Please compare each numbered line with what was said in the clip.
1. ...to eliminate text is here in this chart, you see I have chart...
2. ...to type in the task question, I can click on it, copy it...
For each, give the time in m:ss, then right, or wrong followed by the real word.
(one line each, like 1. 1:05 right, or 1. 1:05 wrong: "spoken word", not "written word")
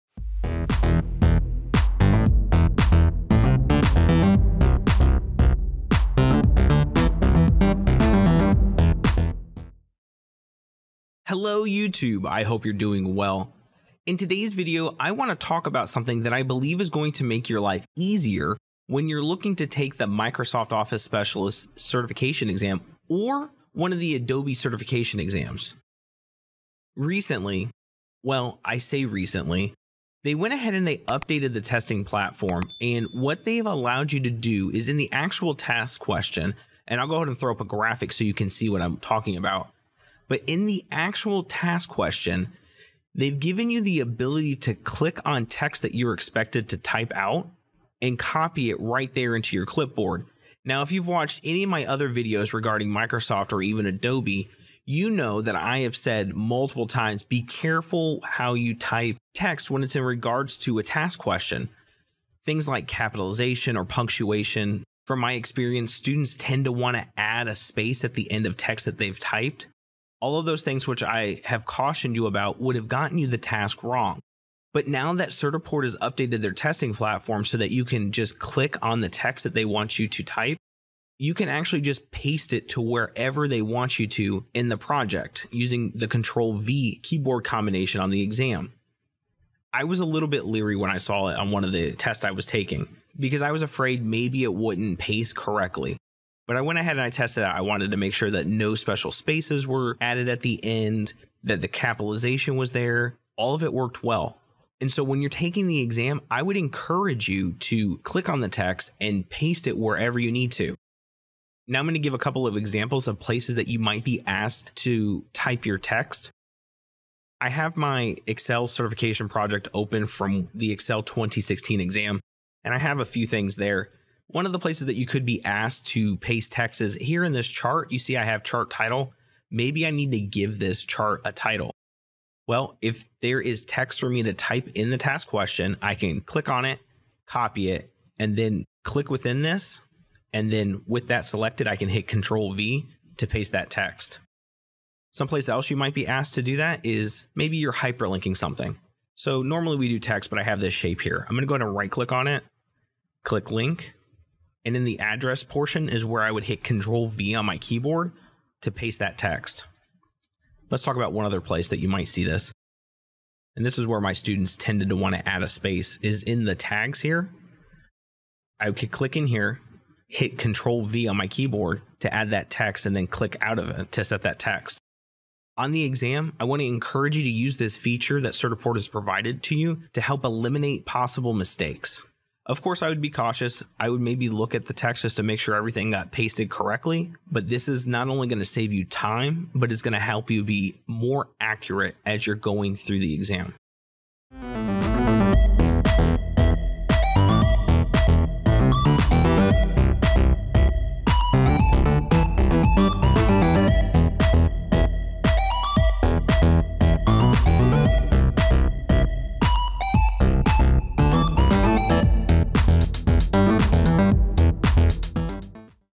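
1. 2:05 wrong: "paste", not "eliminate"
2. 2:14 right.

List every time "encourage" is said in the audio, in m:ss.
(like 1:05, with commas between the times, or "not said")
1:46, 2:56.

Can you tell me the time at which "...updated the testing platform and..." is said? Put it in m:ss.
0:31.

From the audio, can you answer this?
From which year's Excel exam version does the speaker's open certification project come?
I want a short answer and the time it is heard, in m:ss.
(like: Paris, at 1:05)
2016, at 2:00.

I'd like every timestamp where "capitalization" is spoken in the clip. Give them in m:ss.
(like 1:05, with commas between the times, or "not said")
1:02, 1:41.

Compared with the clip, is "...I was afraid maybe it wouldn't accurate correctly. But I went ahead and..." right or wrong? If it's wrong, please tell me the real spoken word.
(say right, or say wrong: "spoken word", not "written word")
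wrong: "paste", not "accurate".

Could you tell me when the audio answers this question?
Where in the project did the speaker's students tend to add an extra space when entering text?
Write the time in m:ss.
2:46.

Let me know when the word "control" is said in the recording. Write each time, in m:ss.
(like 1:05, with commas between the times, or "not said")
1:26, 2:22, 2:36, 2:50.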